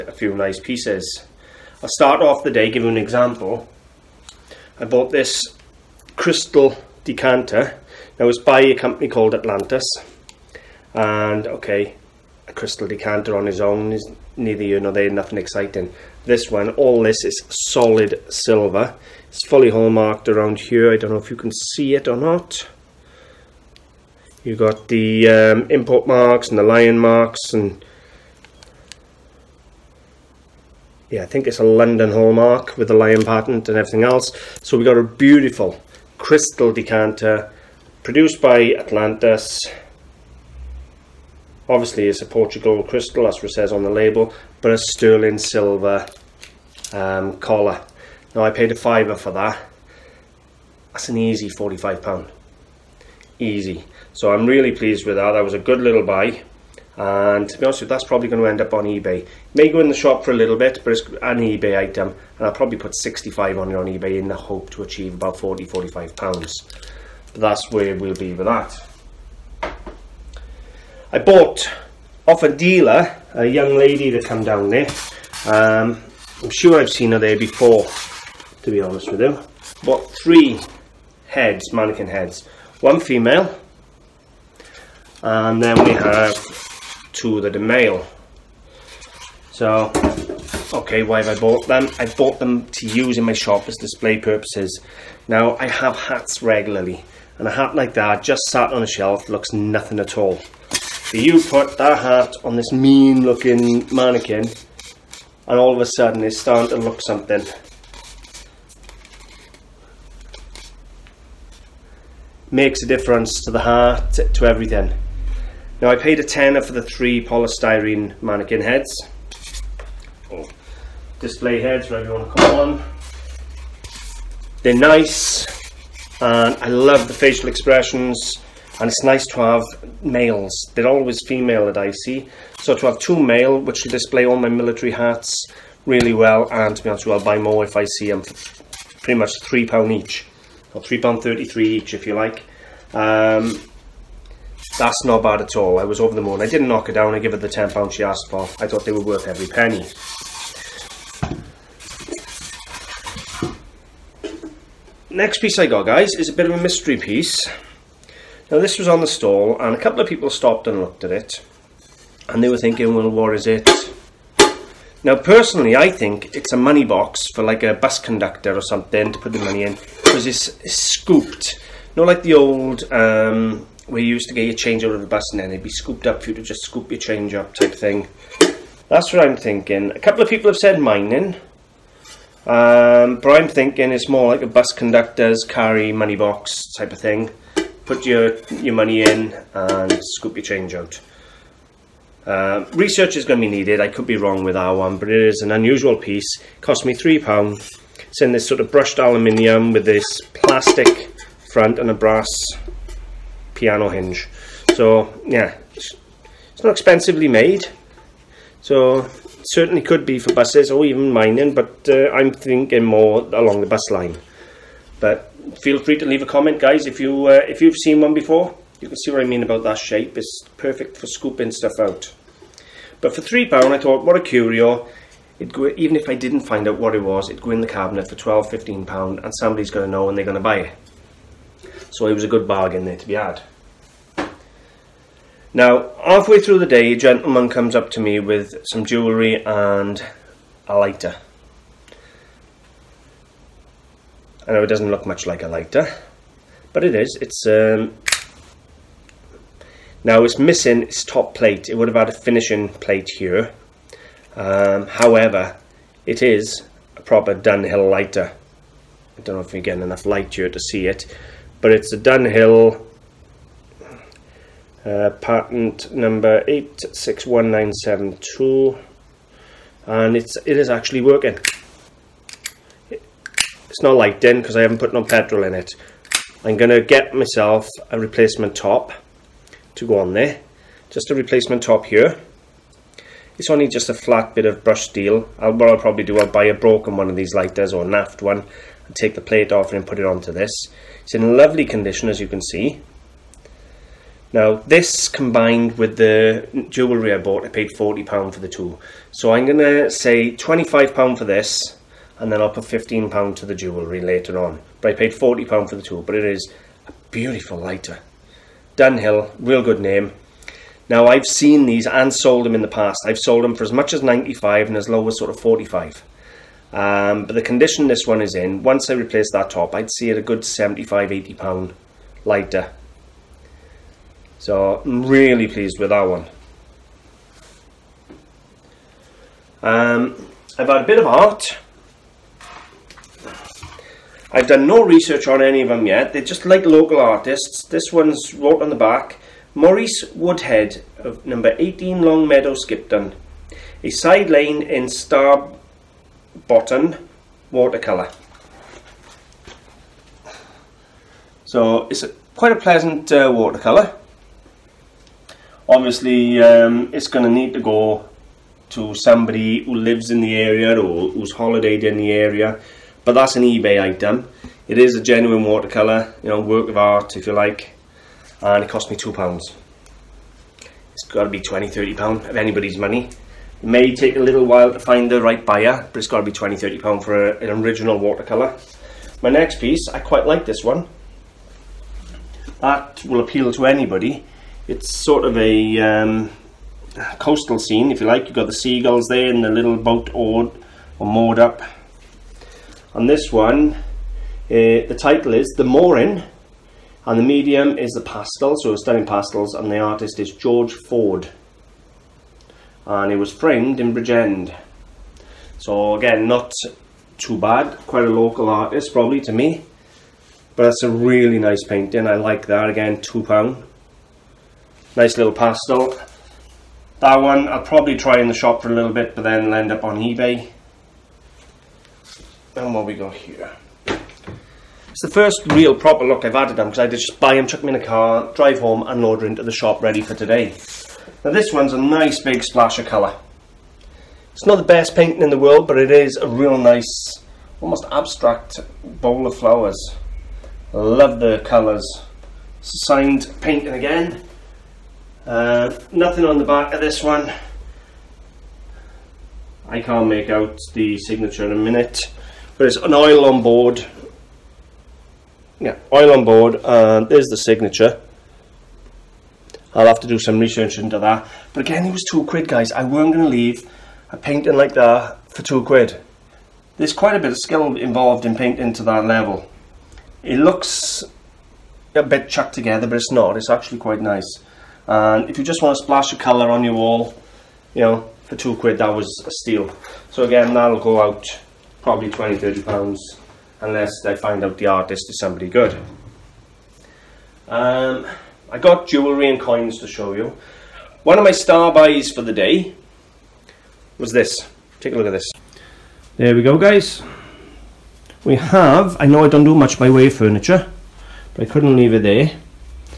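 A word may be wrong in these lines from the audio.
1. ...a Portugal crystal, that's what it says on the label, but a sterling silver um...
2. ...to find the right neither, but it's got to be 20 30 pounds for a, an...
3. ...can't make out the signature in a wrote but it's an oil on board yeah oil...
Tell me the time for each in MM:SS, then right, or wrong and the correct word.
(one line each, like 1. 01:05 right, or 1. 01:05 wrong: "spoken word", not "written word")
1. 00:42 right
2. 06:14 wrong: "buyer", not "neither"
3. 07:29 wrong: "minute", not "wrote".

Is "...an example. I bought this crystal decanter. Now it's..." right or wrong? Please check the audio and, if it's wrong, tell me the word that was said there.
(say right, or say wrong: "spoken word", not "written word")
right.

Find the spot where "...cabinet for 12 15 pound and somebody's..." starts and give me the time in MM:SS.
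03:47.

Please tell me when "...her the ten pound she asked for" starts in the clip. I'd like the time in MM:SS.
02:27.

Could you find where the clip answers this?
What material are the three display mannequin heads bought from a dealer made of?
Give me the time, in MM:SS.
01:57.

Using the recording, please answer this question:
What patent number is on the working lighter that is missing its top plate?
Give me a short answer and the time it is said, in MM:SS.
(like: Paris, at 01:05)
861972, at 04:26.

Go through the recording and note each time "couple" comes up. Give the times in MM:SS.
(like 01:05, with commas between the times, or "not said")
02:39, 02:59.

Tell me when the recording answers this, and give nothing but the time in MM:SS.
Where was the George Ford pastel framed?
06:43.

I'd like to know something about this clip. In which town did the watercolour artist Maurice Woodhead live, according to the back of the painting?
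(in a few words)
Skipton.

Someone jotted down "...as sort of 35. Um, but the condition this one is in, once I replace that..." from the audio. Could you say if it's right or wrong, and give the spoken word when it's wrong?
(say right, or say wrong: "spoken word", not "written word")
wrong: "45", not "35".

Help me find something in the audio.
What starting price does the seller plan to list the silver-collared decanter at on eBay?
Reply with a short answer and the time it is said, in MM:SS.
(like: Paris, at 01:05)
£65, at 01:02.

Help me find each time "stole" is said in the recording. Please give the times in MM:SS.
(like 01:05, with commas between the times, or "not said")
not said.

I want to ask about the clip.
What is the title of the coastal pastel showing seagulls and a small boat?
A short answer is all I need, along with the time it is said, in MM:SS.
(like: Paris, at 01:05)
The Mooring, at 06:35.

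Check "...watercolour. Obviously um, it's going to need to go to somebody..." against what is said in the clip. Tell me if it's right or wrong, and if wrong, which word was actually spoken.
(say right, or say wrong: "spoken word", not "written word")
right.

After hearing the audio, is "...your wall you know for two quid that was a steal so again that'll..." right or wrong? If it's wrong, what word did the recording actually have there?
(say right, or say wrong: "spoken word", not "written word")
right.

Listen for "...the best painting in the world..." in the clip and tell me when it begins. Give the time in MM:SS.
07:14.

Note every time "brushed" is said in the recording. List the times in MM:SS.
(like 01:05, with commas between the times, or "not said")
03:18, 04:44.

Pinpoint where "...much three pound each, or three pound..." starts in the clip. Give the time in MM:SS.
02:19.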